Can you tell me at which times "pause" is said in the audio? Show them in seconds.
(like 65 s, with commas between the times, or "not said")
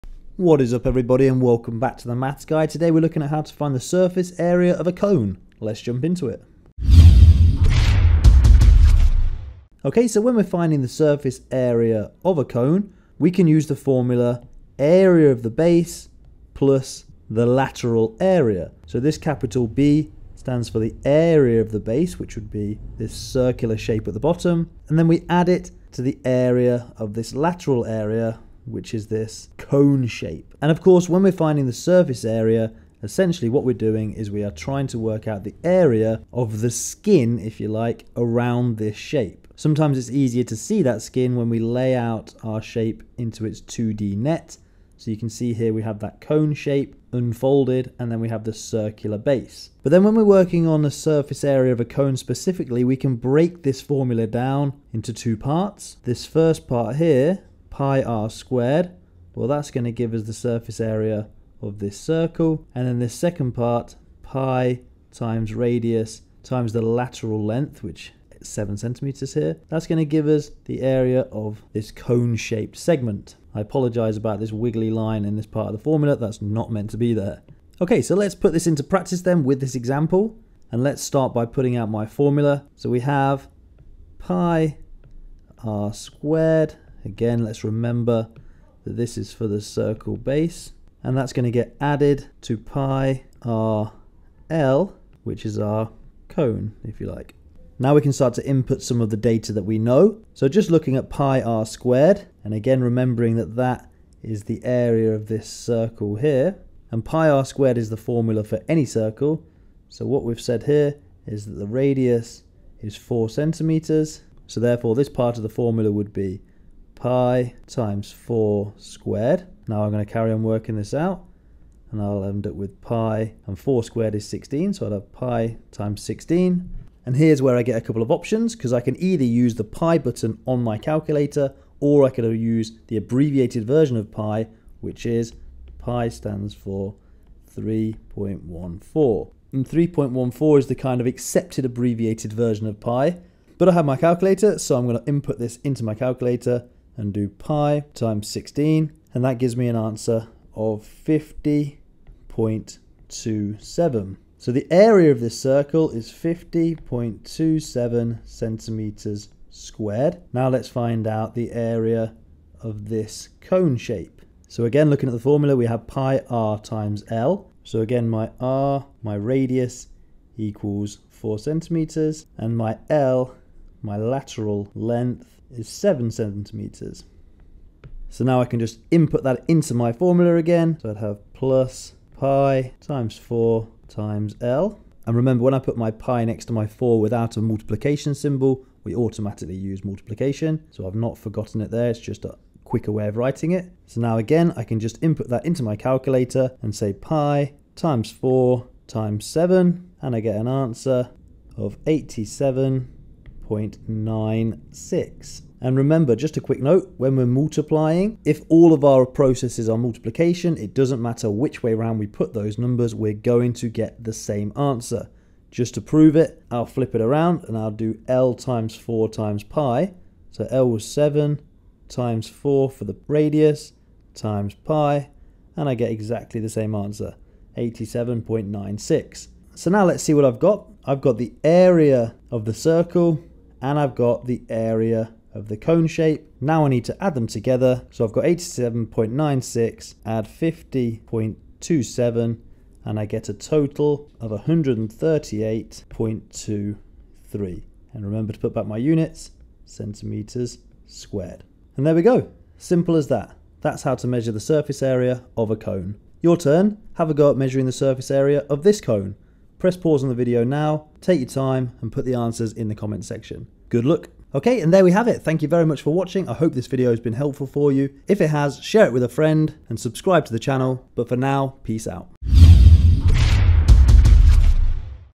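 259 s.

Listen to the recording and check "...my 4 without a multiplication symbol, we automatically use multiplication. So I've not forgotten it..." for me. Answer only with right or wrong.
right.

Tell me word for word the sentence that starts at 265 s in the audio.
Thank you very much for watching.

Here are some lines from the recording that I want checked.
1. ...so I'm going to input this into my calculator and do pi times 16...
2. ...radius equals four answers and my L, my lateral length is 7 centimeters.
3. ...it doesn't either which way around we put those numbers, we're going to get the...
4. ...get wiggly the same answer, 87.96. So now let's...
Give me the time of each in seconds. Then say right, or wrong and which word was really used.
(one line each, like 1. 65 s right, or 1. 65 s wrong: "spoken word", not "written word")
1. 144 s right
2. 169 s wrong: "centimeters", not "answers"
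3. 210 s wrong: "matter", not "either"
4. 225 s wrong: "exactly", not "wiggly".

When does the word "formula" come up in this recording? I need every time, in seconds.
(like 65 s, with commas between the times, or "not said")
13 s, 53 s, 75 s, 82 s, 107 s, 115 s, 165 s, 179 s.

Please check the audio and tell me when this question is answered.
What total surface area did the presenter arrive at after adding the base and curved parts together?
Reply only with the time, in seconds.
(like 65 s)
244 s.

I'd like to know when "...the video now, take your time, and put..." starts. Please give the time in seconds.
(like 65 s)
260 s.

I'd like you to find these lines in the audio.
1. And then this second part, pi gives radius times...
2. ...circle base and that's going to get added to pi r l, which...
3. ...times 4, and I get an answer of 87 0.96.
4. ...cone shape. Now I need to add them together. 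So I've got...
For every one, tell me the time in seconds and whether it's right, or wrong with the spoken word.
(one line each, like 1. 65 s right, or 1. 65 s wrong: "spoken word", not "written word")
1. 62 s wrong: "times", not "gives"
2. 89 s right
3. 198 s wrong: "7", not "4"
4. 235 s right.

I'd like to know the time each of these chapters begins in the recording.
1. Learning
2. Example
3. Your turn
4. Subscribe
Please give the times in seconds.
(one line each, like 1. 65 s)
1. 10 s
2. 40 s
3. 256 s
4. 270 s.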